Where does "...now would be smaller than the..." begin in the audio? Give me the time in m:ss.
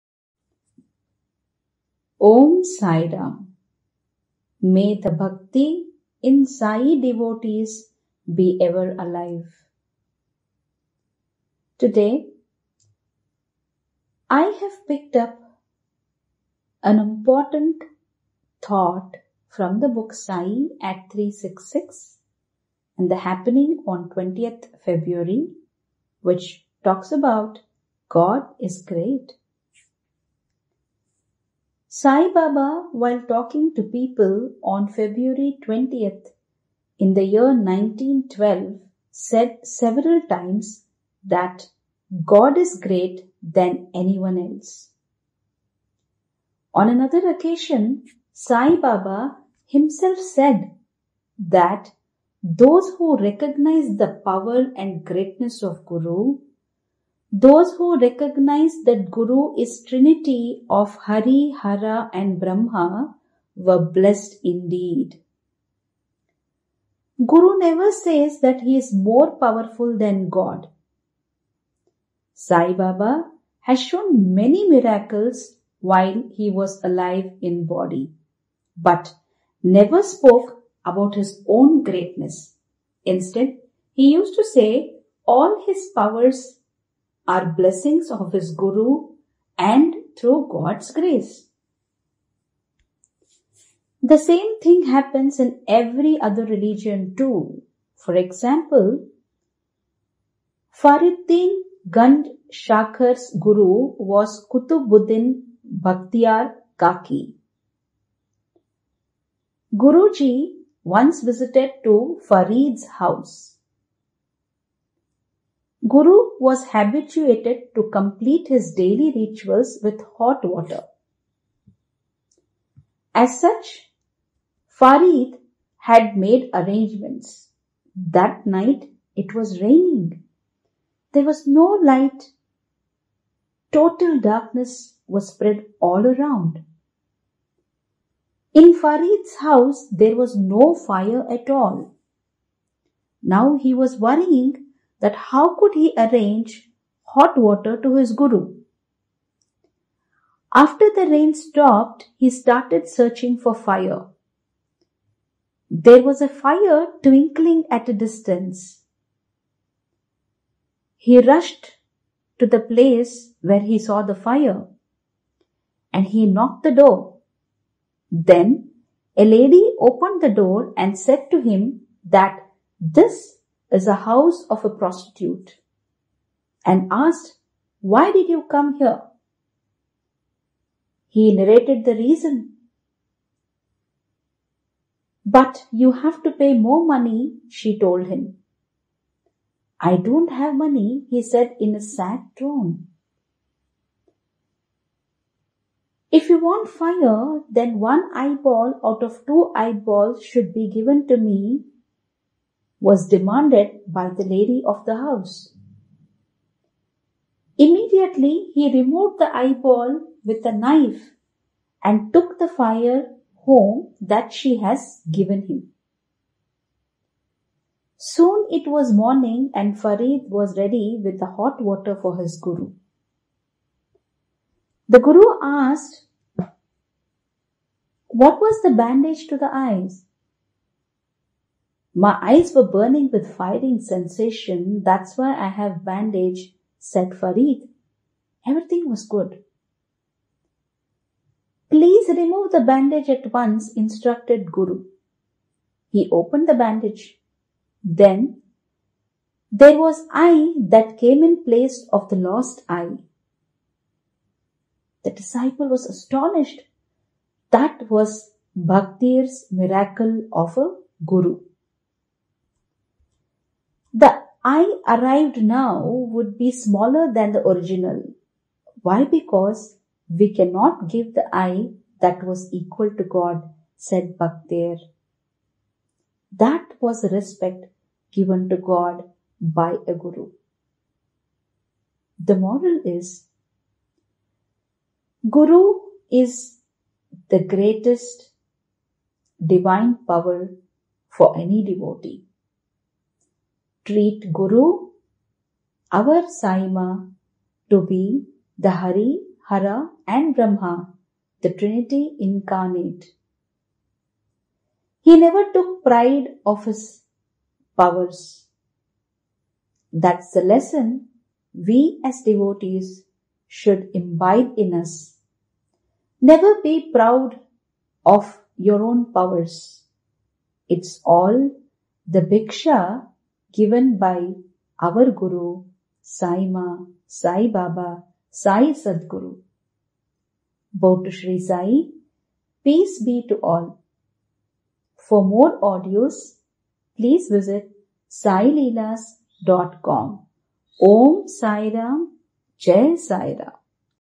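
4:25.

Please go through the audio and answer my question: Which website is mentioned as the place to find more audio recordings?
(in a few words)
saileelas.com.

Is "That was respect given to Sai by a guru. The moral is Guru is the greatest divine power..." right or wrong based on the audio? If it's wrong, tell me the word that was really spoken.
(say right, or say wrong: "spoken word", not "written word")
wrong: "God", not "Sai".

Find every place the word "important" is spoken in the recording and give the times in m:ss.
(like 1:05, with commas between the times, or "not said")
0:16.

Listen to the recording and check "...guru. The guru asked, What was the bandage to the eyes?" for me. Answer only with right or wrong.
right.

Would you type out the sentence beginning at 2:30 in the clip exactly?
After the rain stopped, he started searching for fire.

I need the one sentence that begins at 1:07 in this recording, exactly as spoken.
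Guru never says that he is more powerful than God.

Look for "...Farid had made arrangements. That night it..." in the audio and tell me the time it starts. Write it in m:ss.
2:04.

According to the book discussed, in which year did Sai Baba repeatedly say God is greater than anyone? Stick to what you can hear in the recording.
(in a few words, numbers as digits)
1912.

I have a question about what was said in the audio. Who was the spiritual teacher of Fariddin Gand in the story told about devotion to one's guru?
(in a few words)
Kutubuddin Bhaktiar Kaki.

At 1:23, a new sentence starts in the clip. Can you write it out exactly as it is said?
Instead, he used to say all his powers are blessings of his Guru and through God's grace.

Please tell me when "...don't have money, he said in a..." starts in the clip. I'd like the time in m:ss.
3:09.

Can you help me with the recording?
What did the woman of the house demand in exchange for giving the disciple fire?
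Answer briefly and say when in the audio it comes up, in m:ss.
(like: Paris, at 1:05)
One eyeball, at 3:17.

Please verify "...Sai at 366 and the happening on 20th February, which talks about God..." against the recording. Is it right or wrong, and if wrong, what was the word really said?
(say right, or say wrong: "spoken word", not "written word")
right.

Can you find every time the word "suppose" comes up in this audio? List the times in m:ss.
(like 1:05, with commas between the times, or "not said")
not said.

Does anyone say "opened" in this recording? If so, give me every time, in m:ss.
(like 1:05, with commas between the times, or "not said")
2:49, 4:06.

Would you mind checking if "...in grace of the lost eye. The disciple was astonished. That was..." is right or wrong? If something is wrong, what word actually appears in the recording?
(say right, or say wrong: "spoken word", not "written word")
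wrong: "place", not "grace".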